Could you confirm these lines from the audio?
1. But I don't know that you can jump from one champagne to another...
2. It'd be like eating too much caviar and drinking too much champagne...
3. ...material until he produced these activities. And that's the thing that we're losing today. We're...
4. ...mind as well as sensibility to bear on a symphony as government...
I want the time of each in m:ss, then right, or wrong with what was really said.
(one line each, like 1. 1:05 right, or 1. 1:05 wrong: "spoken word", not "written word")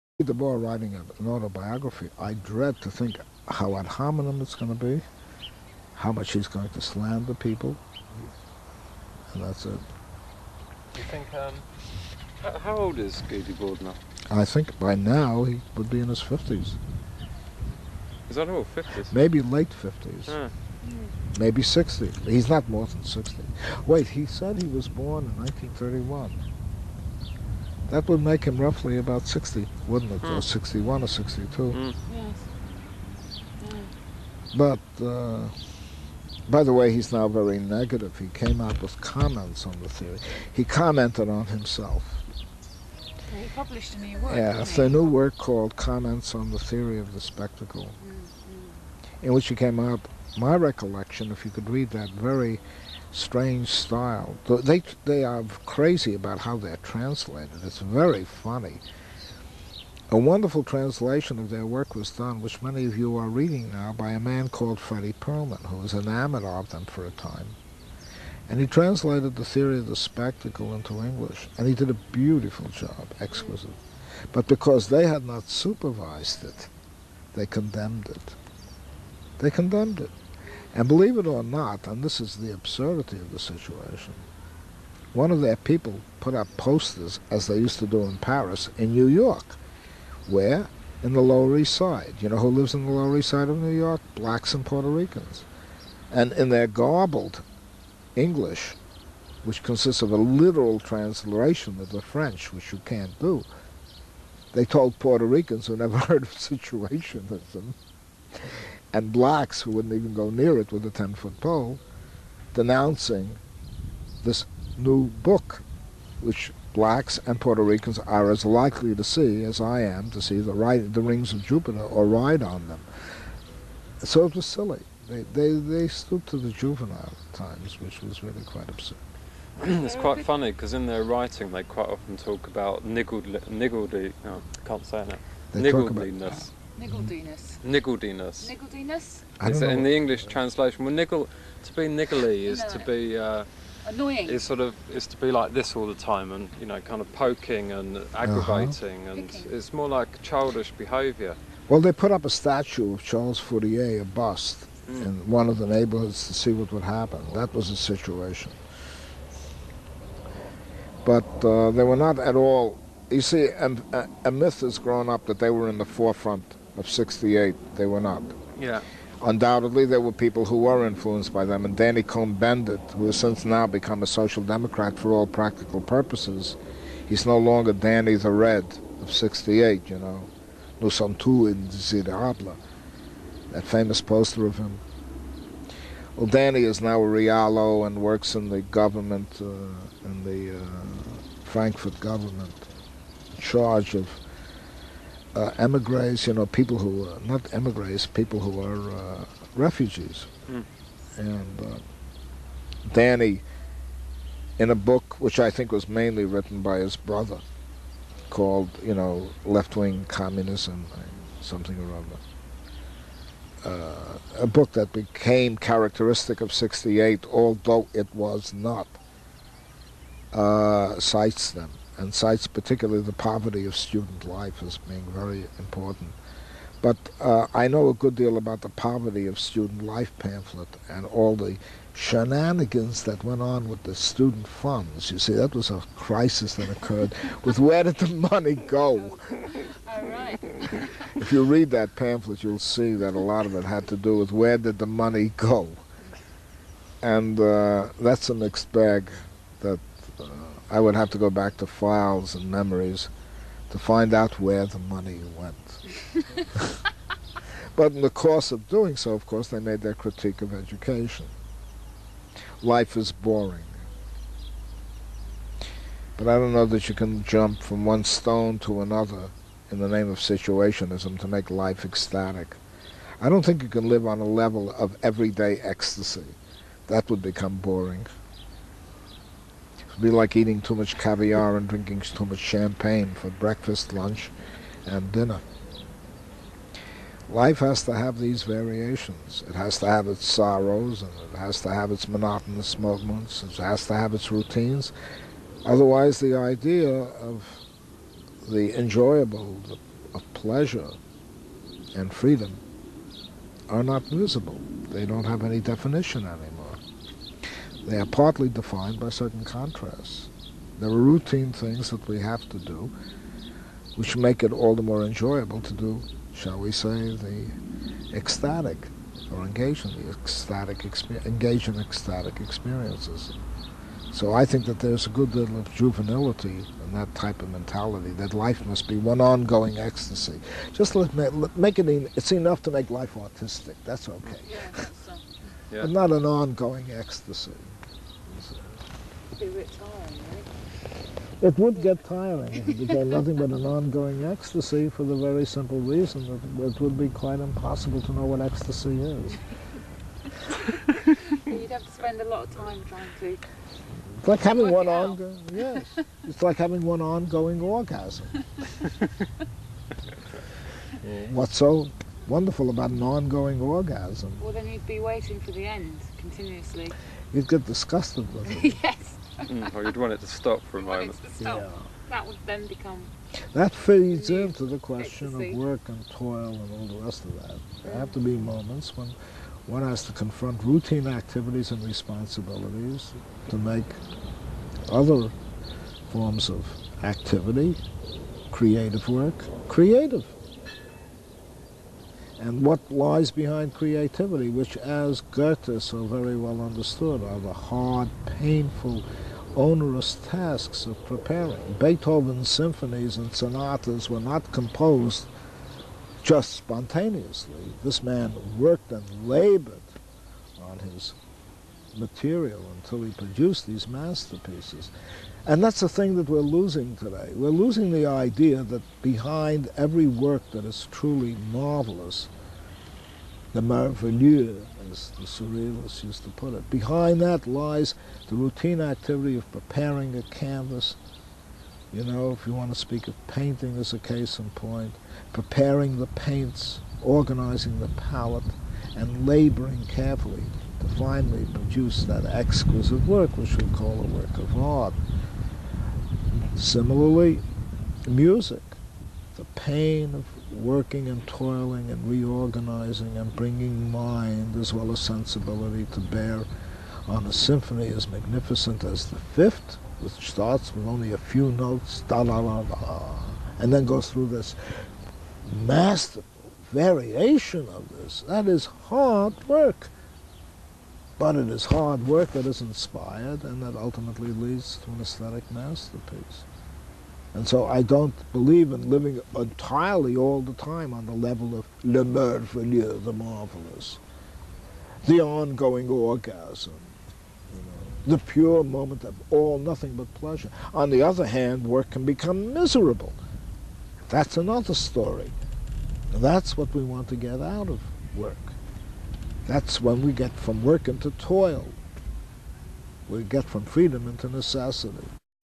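1. 4:26 wrong: "stone", not "champagne"
2. 4:39 right
3. 6:51 wrong: "masterpieces", not "activities"
4. 7:33 wrong: "magnificent", not "government".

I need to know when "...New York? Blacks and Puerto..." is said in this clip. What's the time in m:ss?
1:33.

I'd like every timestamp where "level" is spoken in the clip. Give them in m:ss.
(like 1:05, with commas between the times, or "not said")
4:34, 8:01.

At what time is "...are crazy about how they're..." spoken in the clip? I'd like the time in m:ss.
0:55.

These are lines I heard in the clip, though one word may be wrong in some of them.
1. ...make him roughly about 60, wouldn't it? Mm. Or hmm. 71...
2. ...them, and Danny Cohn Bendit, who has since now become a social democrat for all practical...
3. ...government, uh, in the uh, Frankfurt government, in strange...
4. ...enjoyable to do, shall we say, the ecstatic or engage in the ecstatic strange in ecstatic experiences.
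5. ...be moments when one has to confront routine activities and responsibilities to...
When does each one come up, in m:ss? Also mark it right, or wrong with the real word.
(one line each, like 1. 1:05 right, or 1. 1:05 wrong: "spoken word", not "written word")
1. 0:28 wrong: "61", not "71"
2. 2:51 right
3. 3:08 wrong: "charge", not "strange"
4. 5:15 wrong: "engage", not "strange"
5. 6:18 right.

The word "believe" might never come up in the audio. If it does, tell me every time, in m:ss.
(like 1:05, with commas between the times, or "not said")
1:20, 7:58.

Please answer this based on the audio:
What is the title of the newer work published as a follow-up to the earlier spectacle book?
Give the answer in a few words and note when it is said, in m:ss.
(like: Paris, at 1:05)
Comments on the Theory of the Spectacle, at 0:45.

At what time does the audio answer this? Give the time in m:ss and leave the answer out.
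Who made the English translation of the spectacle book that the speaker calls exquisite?
1:04.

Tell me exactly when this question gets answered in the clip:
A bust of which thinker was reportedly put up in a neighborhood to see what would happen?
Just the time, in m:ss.
2:33.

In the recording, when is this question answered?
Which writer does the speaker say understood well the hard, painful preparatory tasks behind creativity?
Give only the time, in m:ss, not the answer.
6:35.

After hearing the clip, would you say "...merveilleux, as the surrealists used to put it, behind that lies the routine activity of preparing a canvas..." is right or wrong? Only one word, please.
right.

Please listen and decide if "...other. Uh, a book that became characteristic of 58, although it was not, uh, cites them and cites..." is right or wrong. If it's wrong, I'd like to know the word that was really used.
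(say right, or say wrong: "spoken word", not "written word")
wrong: "68", not "58".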